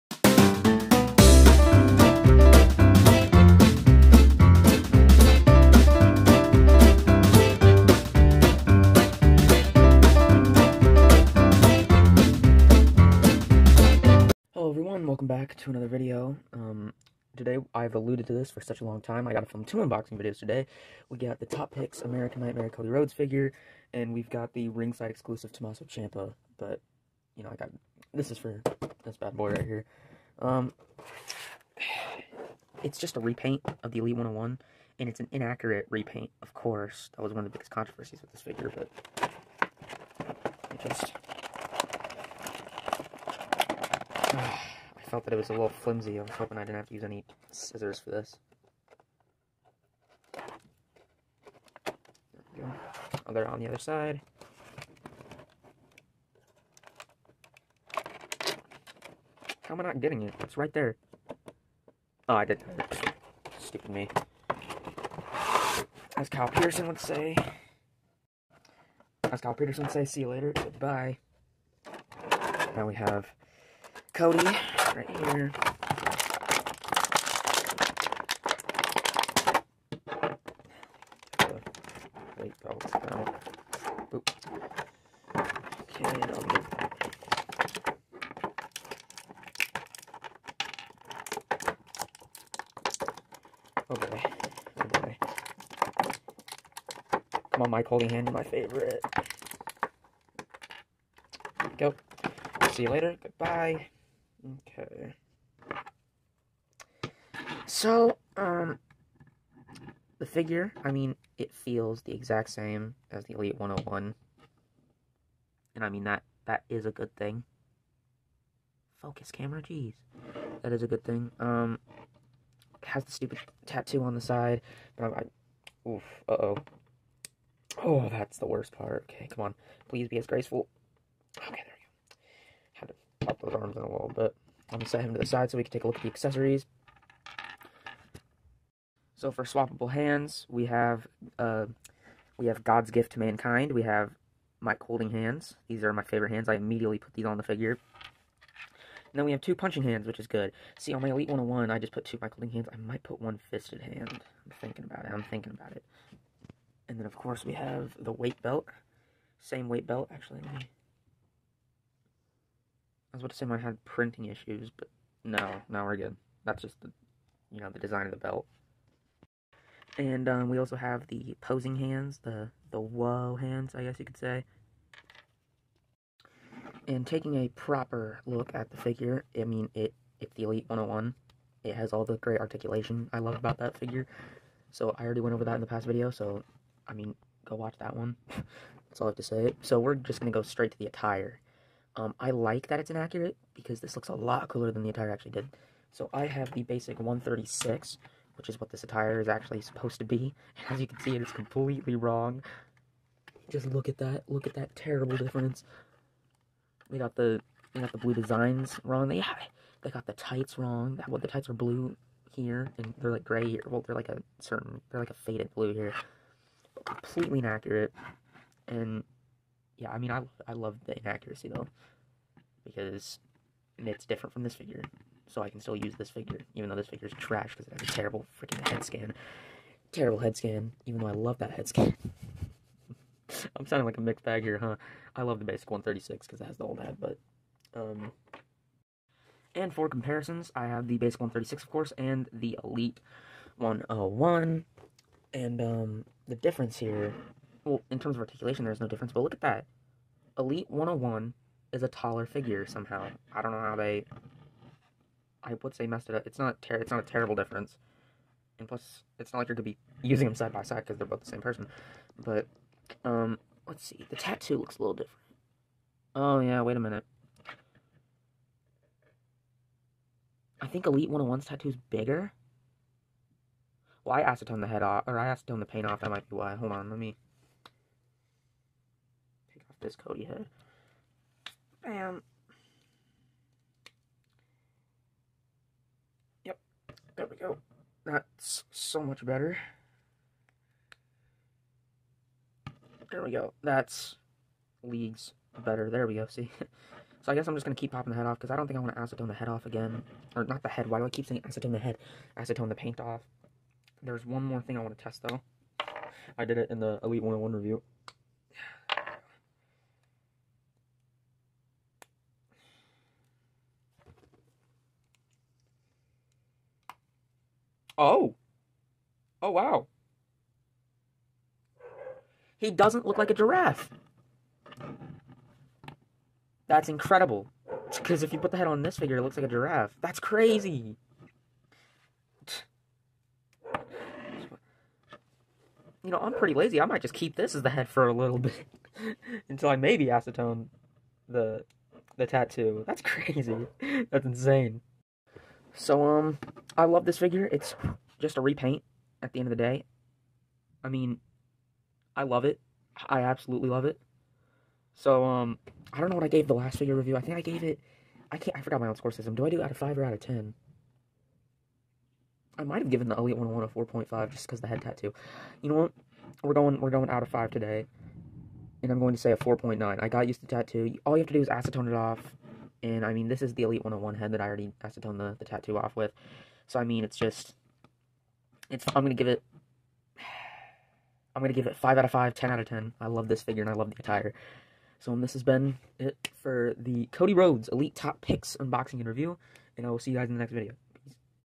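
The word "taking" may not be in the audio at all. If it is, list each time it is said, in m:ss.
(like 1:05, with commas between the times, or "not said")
2:57.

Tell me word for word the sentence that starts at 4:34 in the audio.
Well, I acetone the head off, or I acetone the paint off.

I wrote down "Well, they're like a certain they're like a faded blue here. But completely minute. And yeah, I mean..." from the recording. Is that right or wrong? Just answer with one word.
wrong.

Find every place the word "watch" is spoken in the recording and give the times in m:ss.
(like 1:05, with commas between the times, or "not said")
3:07.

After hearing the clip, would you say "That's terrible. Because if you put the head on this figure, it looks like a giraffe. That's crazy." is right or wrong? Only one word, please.
wrong.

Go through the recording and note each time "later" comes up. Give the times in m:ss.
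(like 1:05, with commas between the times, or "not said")
1:10, 1:42.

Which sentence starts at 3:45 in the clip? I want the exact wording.
So I can still use this figure, even though this figure is trash because it has a terrible freaking head scan.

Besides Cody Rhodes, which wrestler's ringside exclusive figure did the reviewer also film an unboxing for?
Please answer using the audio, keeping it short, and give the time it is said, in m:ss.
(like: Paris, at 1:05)
Tommaso Ciampa, at 0:25.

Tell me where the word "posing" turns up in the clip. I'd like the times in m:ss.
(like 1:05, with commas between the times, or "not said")
2:51.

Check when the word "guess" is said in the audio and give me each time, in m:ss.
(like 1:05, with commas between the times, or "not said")
2:53, 4:57.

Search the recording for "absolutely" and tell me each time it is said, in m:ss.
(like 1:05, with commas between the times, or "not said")
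5:53.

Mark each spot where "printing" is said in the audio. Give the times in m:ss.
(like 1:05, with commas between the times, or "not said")
2:43.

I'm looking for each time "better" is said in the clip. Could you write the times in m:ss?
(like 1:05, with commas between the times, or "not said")
4:49, 4:55.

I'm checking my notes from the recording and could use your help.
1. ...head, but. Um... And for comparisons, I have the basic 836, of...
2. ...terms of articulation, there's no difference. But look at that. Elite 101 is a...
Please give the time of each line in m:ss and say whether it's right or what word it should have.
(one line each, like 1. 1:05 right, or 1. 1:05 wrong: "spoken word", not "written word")
1. 3:56 wrong: "136", not "836"
2. 4:07 right.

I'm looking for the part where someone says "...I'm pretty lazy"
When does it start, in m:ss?
5:36.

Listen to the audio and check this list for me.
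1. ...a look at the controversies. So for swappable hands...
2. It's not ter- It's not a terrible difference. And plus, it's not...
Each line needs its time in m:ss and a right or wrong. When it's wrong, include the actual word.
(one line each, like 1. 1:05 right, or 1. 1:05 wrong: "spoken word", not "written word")
1. 2:15 wrong: "accessories", not "controversies"
2. 4:16 right.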